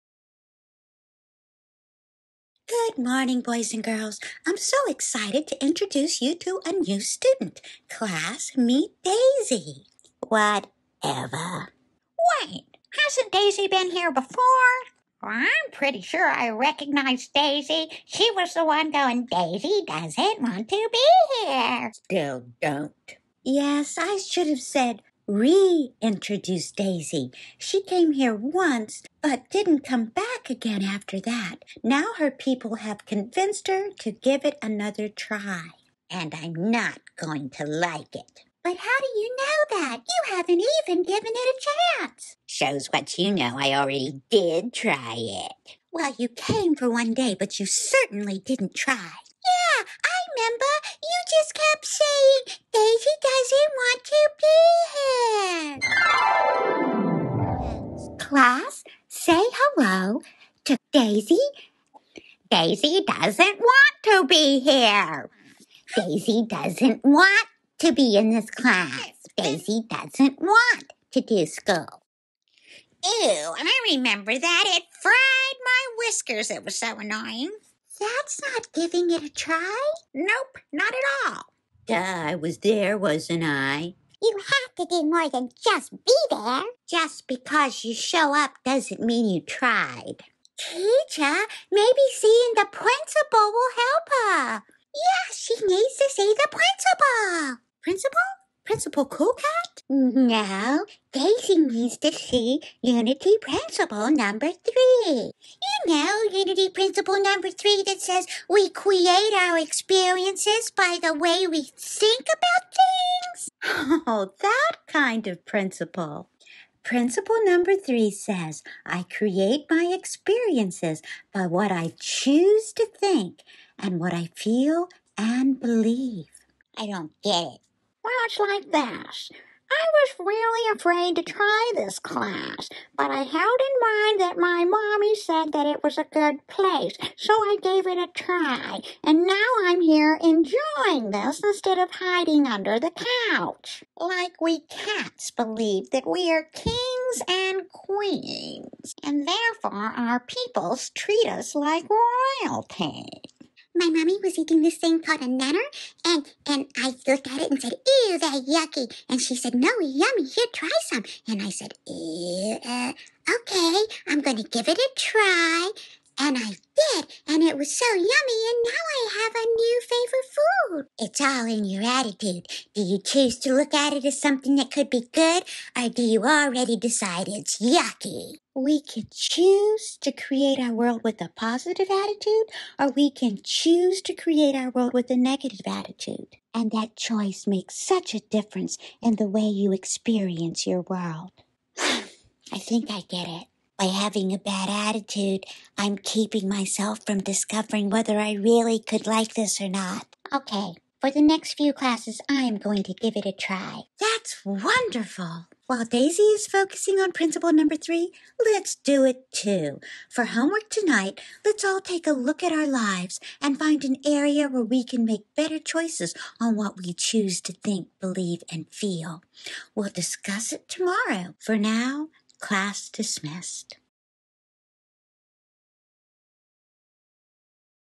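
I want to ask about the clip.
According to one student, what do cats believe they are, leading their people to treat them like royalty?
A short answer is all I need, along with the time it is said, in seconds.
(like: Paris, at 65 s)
Kings and queens, at 146 s.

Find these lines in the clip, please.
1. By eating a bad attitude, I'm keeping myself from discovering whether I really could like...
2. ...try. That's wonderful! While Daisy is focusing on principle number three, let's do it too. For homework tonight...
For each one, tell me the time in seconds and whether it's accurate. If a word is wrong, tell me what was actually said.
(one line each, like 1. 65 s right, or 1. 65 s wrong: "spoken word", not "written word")
1. 193 s wrong: "having", not "eating"
2. 203 s right.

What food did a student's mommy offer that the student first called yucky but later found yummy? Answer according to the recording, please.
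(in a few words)
Nanner.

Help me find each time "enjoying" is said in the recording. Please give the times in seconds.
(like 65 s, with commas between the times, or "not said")
140 s.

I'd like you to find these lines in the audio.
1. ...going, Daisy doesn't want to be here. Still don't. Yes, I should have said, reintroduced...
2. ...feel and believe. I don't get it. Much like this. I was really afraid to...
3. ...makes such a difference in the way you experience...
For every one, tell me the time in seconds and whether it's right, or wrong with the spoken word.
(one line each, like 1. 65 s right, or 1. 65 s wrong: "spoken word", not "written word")
1. 18 s right
2. 124 s right
3. 187 s right.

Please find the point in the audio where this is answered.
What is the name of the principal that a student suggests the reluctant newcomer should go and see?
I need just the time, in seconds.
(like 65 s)
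98 s.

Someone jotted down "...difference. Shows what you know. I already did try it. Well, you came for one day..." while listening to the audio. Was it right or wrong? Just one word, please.
wrong.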